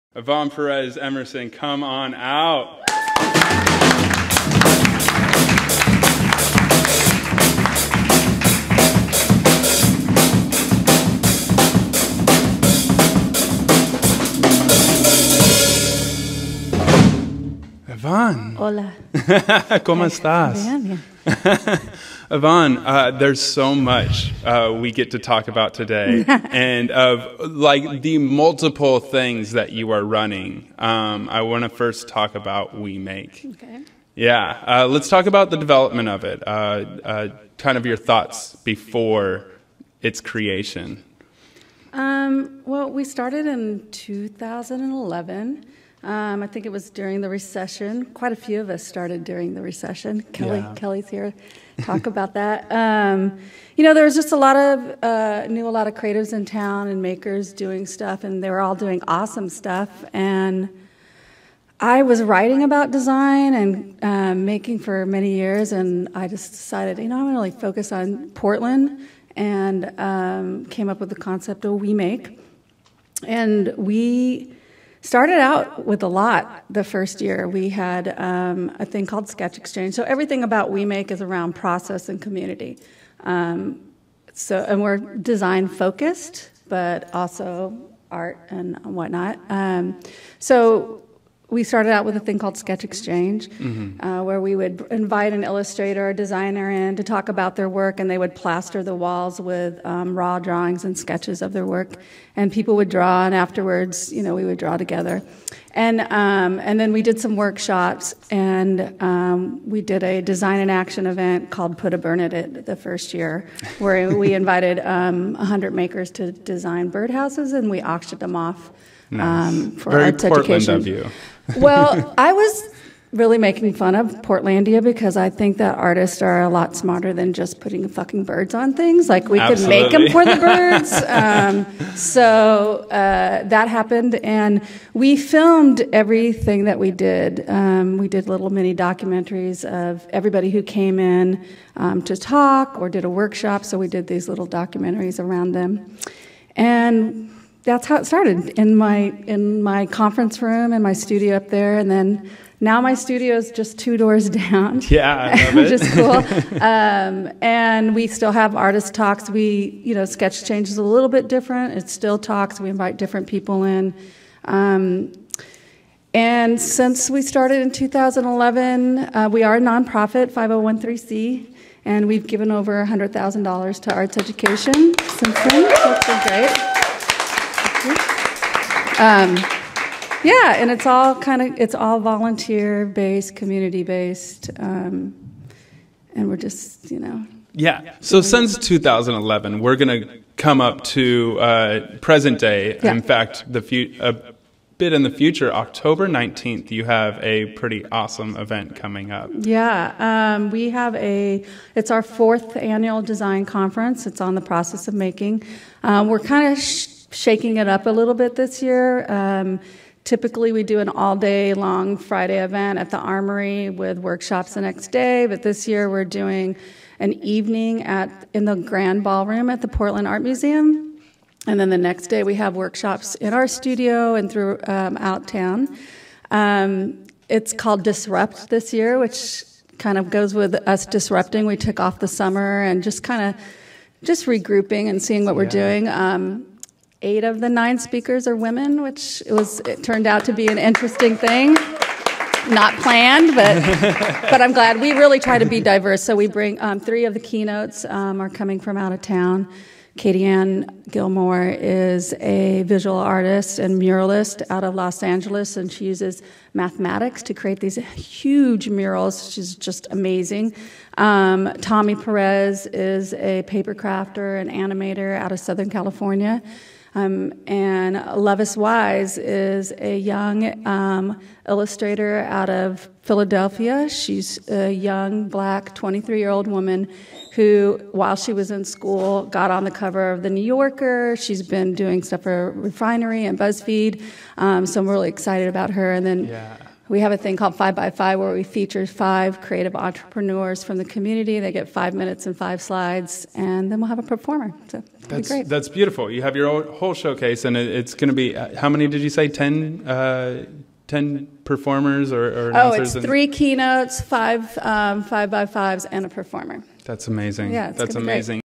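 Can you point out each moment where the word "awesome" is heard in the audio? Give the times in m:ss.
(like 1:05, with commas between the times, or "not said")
0:59, 3:17.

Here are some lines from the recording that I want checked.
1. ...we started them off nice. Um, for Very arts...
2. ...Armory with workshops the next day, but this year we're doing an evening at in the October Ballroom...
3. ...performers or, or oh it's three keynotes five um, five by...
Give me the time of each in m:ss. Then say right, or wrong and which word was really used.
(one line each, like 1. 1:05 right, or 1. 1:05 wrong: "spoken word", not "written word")
1. 1:57 wrong: "auctioned", not "started"
2. 3:32 wrong: "Grand", not "October"
3. 5:01 right.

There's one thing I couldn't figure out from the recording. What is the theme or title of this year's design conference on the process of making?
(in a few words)
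Disrupt.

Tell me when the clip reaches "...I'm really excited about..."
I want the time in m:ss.
4:44.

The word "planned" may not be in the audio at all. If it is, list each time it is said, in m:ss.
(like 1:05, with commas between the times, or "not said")
4:02.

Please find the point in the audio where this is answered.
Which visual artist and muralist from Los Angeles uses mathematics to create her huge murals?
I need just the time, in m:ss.
4:09.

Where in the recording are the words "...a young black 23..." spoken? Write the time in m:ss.
4:34.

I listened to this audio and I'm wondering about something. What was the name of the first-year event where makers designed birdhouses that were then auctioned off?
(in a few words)
Put a Bird on It.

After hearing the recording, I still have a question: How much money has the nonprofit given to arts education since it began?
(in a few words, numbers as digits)
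$100,000.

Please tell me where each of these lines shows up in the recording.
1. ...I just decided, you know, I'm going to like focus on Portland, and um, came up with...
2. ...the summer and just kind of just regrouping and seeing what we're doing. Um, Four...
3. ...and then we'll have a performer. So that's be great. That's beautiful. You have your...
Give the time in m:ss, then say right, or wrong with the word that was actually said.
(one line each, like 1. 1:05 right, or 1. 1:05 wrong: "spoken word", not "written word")
1. 1:06 right
2. 3:51 wrong: "Eight", not "Four"
3. 4:53 right.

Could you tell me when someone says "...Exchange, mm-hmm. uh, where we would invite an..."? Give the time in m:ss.
1:32.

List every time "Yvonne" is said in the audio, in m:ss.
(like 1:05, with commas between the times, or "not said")
0:00, 0:18, 0:22.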